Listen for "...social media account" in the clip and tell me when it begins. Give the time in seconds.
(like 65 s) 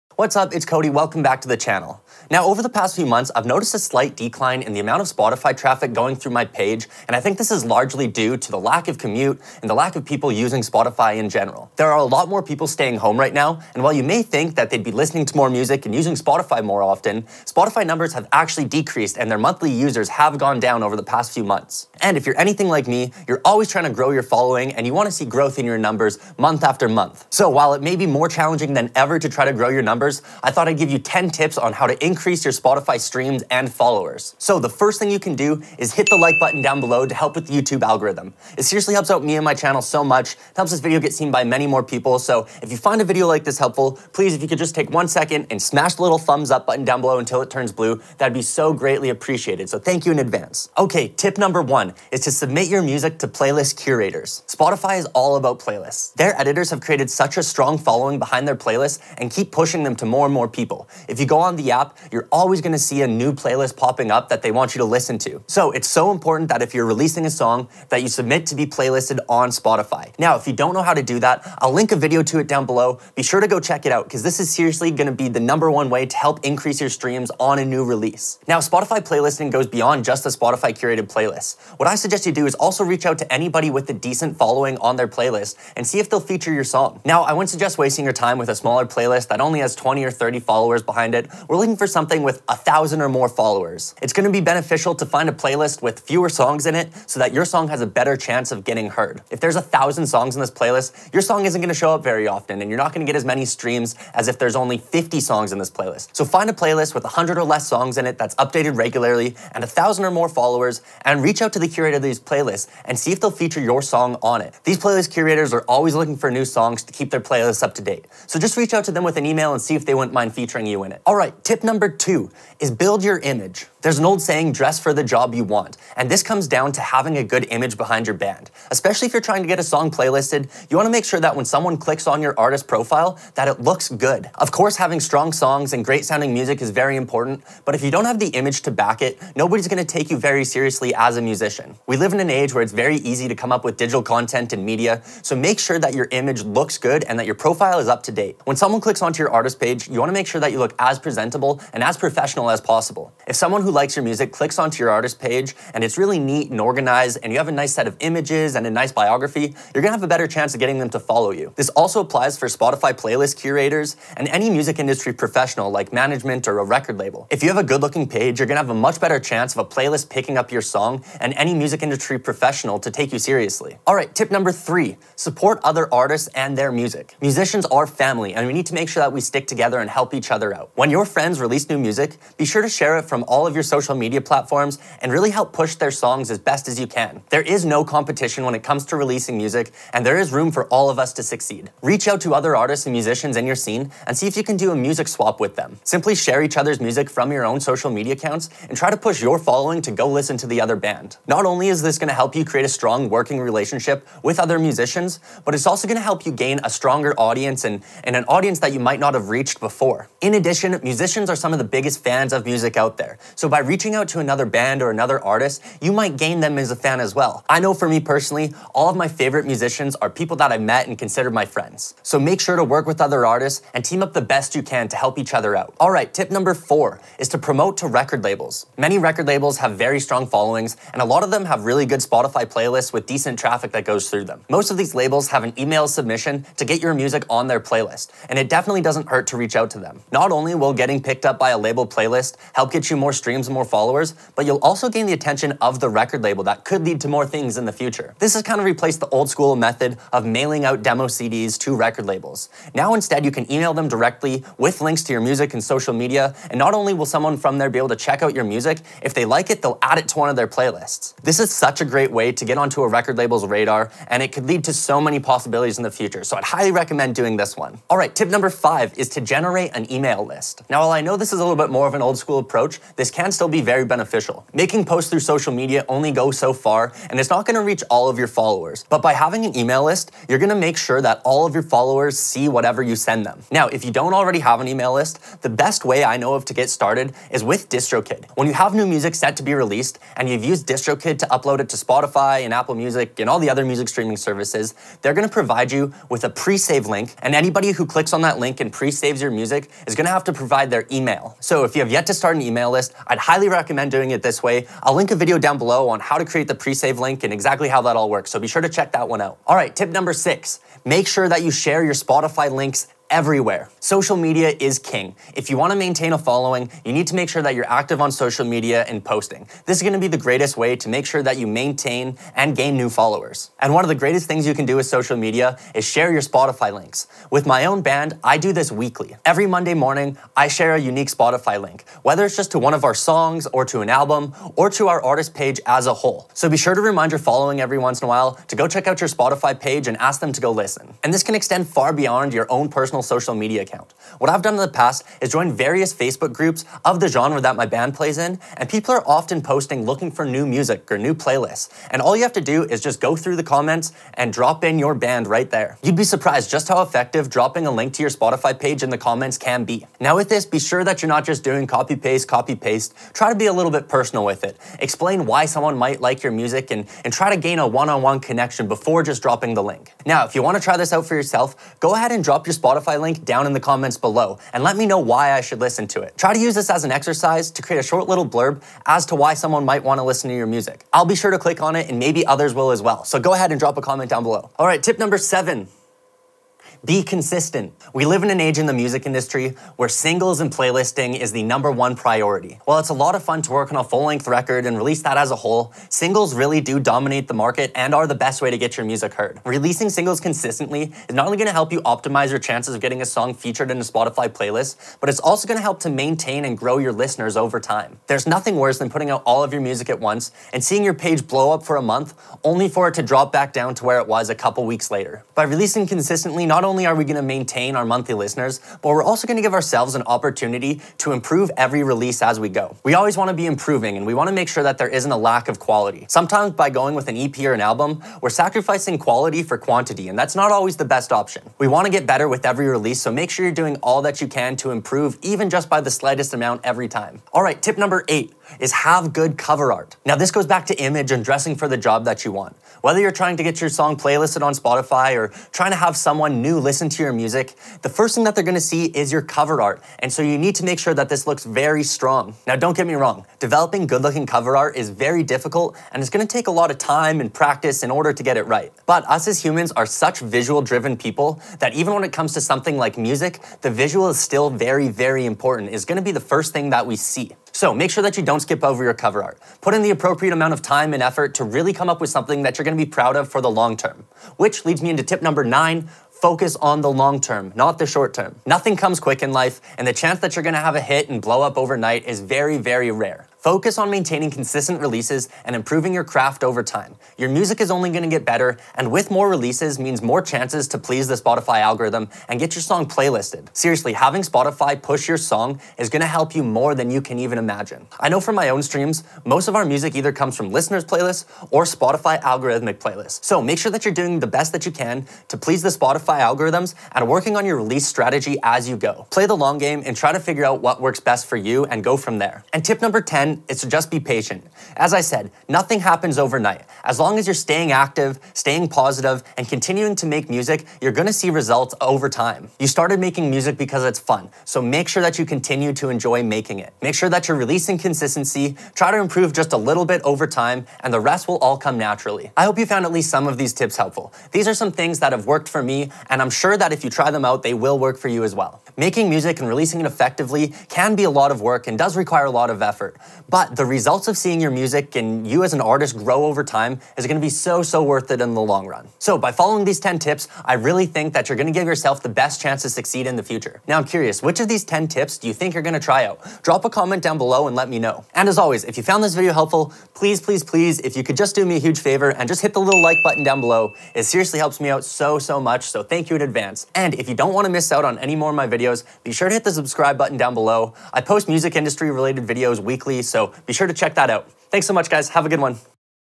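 343 s.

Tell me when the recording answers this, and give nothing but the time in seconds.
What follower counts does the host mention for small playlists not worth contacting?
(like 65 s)
89 s.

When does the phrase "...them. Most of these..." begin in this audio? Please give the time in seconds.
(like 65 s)
234 s.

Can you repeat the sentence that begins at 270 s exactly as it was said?
Now, while I know this is a little bit more of an old school approach, this can can still be very beneficial.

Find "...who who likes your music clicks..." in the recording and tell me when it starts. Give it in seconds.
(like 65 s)
153 s.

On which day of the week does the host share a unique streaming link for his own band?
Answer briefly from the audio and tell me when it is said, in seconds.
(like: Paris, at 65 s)
Monday, at 329 s.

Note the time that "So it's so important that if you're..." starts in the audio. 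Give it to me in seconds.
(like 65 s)
65 s.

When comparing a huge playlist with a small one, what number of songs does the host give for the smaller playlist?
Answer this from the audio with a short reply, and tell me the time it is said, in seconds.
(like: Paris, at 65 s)
50, at 104 s.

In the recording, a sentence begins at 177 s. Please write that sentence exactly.
Musicians are family and we need to make sure that we stick together and help each other out.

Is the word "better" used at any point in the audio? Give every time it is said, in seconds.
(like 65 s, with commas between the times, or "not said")
97 s, 160 s, 168 s, 432 s, 488 s.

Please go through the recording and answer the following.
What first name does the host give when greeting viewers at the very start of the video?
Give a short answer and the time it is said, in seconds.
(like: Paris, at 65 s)
Cody, at 0 s.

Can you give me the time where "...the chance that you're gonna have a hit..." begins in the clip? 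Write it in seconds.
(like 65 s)
479 s.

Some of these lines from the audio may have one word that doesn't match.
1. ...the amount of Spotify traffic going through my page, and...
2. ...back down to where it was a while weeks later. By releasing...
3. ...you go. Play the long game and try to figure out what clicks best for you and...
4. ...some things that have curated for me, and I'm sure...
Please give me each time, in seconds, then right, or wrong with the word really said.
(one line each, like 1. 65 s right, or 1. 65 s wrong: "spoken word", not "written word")
1. 4 s right
2. 413 s wrong: "couple", not "while"
3. 508 s wrong: "works", not "clicks"
4. 534 s wrong: "worked", not "curated".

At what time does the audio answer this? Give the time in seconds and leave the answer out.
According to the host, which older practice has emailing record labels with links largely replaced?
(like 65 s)
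250 s.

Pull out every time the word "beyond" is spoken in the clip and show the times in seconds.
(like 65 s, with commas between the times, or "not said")
79 s, 341 s.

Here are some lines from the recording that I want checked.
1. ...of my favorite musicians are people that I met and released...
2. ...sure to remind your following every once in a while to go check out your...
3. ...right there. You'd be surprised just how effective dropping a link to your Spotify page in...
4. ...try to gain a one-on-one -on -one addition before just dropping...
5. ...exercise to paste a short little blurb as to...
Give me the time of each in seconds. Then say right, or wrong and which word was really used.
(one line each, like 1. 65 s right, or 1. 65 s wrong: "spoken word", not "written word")
1. 218 s wrong: "considered", not "released"
2. 336 s right
3. 355 s right
4. 367 s wrong: "connection", not "addition"
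5. 376 s wrong: "create", not "paste".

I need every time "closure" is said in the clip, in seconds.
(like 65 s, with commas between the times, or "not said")
not said.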